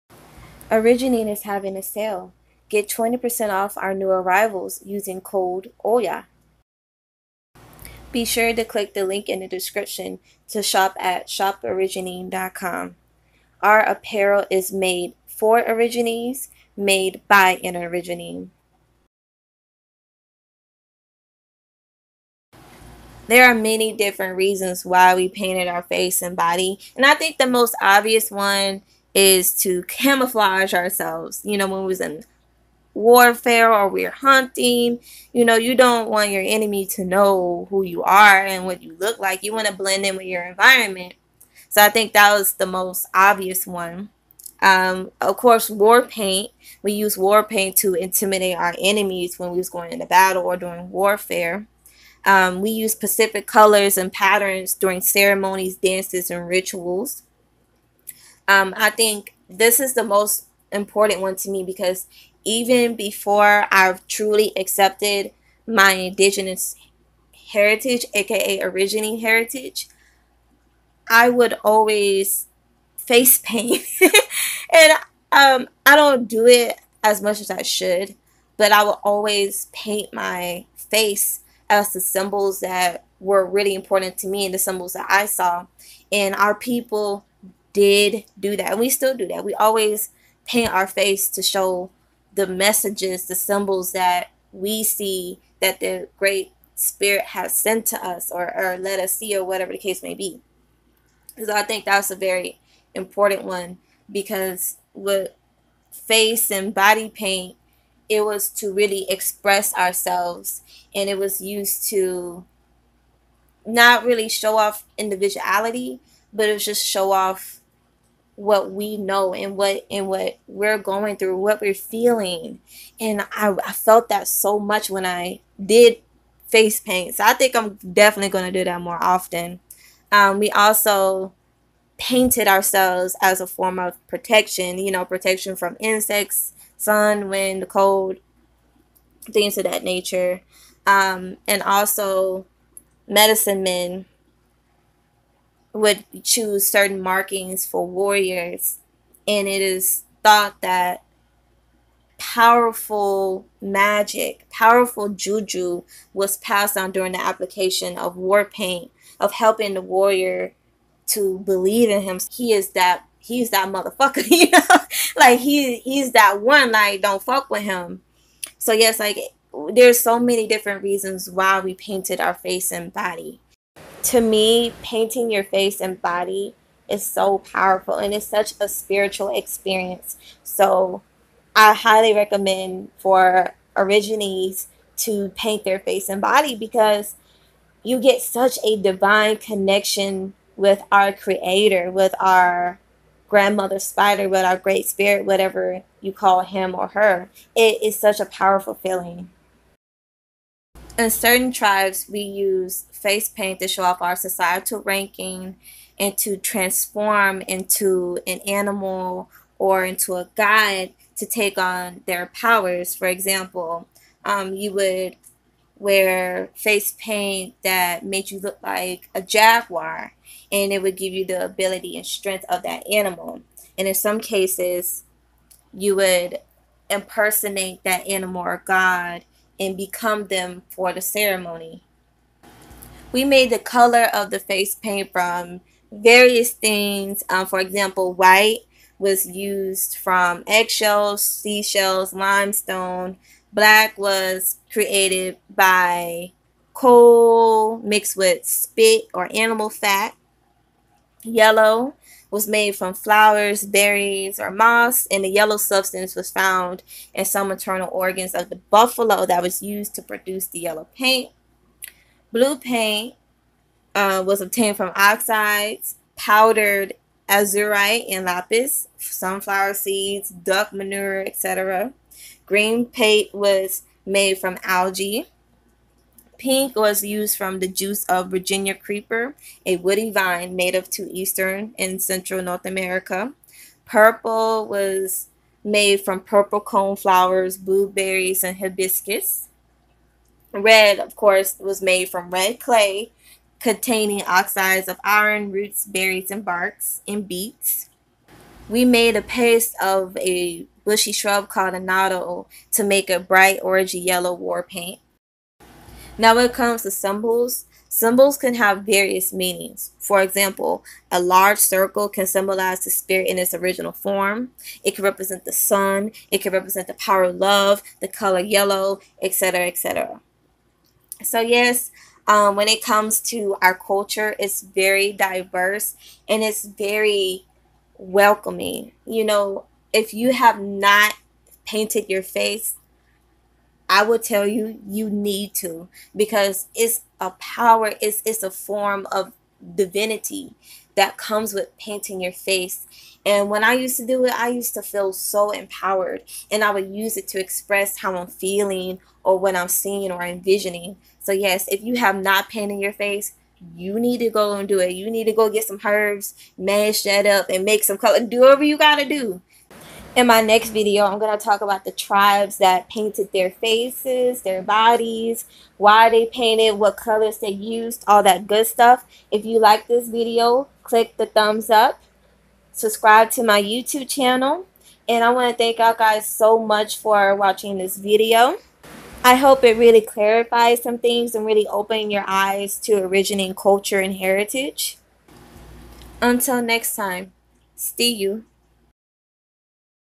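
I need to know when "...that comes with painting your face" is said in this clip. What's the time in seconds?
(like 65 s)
340 s.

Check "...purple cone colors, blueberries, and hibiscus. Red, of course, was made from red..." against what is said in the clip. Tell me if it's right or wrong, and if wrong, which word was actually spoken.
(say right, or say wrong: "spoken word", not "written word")
wrong: "flowers", not "colors".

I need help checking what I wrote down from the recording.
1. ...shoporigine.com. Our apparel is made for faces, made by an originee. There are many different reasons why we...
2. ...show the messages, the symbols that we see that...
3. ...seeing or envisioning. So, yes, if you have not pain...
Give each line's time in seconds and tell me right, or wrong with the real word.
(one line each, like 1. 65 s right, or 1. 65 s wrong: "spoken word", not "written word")
1. 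11 s wrong: "originees", not "faces"
2. 91 s right
3. 349 s right.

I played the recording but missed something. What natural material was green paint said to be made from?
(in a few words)
algae.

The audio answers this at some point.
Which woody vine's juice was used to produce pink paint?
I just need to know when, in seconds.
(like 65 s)
278 s.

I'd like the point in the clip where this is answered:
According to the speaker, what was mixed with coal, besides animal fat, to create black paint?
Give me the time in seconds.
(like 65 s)
248 s.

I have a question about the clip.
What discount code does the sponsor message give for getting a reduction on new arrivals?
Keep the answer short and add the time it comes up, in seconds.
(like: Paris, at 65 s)
OYA, at 5 s.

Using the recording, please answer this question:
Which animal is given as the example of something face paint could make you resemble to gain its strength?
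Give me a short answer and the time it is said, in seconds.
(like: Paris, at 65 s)
jaguar, at 219 s.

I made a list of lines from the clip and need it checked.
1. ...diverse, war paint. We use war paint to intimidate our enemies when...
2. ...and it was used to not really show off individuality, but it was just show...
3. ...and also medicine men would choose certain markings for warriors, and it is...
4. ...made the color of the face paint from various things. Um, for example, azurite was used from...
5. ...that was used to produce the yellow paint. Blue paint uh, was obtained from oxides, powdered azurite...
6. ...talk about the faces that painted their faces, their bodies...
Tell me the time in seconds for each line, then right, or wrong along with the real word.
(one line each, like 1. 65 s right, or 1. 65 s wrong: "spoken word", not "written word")
1. 45 s wrong: "course", not "diverse"
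2. 110 s right
3. 141 s right
4. 233 s wrong: "white", not "azurite"
5. 259 s right
6. 361 s wrong: "tribes", not "faces".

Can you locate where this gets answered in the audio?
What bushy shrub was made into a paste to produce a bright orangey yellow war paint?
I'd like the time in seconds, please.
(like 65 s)
301 s.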